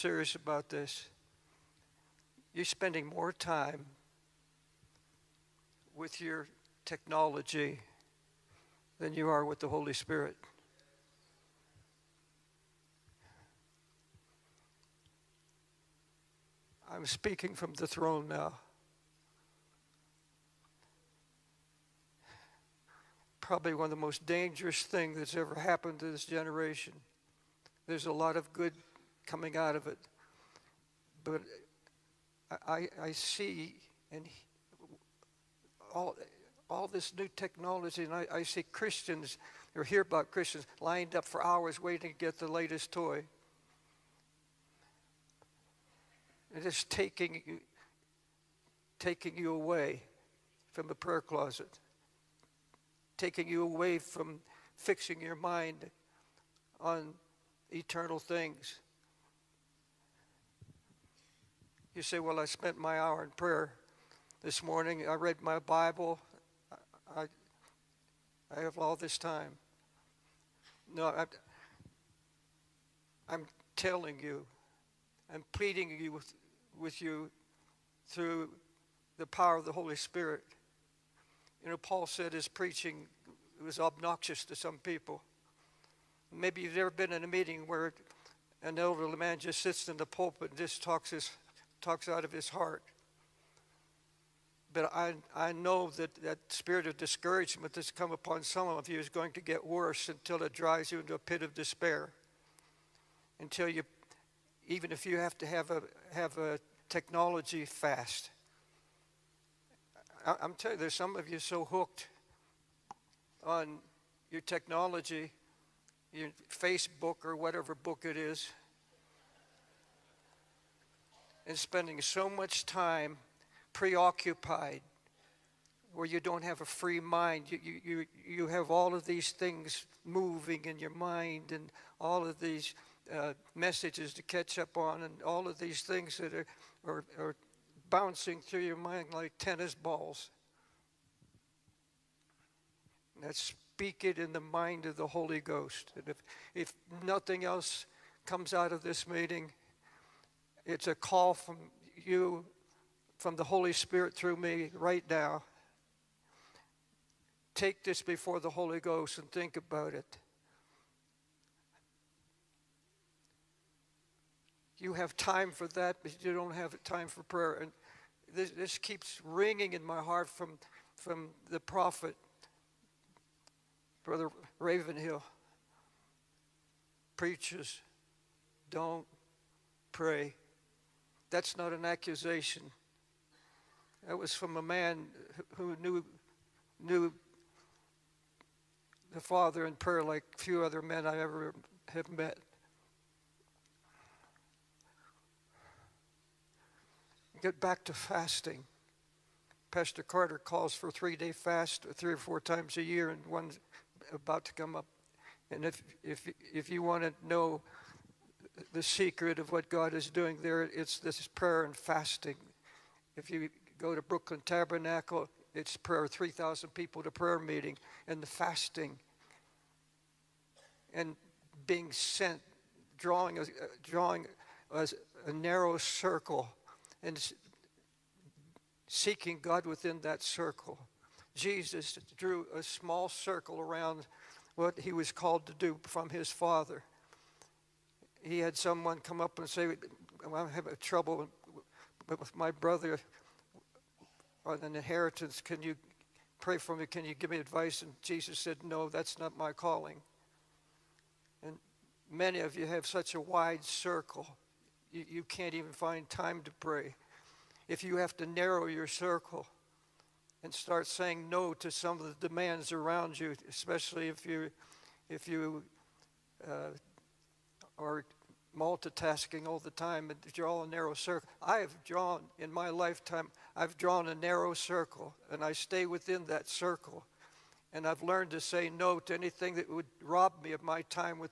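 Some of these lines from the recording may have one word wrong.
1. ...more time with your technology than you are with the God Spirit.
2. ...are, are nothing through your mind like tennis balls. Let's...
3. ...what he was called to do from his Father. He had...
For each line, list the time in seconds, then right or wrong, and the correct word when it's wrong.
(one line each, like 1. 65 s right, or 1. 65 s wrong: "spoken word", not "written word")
1. 3 s wrong: "Holy", not "God"
2. 136 s wrong: "bouncing", not "nothing"
3. 234 s right.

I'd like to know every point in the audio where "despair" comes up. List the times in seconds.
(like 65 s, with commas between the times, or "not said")
101 s.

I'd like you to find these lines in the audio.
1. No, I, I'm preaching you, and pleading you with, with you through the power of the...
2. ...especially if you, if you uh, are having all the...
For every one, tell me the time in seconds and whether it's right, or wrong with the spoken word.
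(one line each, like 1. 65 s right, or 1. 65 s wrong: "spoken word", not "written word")
1. 70 s wrong: "telling", not "preaching"
2. 263 s wrong: "multitasking", not "having".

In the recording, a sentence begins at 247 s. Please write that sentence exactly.
And Jesus said, No, that's not my calling.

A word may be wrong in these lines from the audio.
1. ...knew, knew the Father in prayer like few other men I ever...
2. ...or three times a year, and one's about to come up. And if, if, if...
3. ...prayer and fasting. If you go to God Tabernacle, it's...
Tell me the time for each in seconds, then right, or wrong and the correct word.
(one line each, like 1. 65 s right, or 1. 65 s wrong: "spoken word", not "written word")
1. 185 s right
2. 202 s wrong: "four", not "three"
3. 211 s wrong: "Brooklyn", not "God".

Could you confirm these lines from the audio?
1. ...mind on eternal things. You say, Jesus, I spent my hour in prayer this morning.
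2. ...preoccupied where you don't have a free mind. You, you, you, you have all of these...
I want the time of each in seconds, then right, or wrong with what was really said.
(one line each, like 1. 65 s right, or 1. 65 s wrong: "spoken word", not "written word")
1. 55 s wrong: "Well", not "Jesus"
2. 123 s right.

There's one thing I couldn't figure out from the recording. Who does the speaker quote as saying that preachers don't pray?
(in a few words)
Brother Ravenhill.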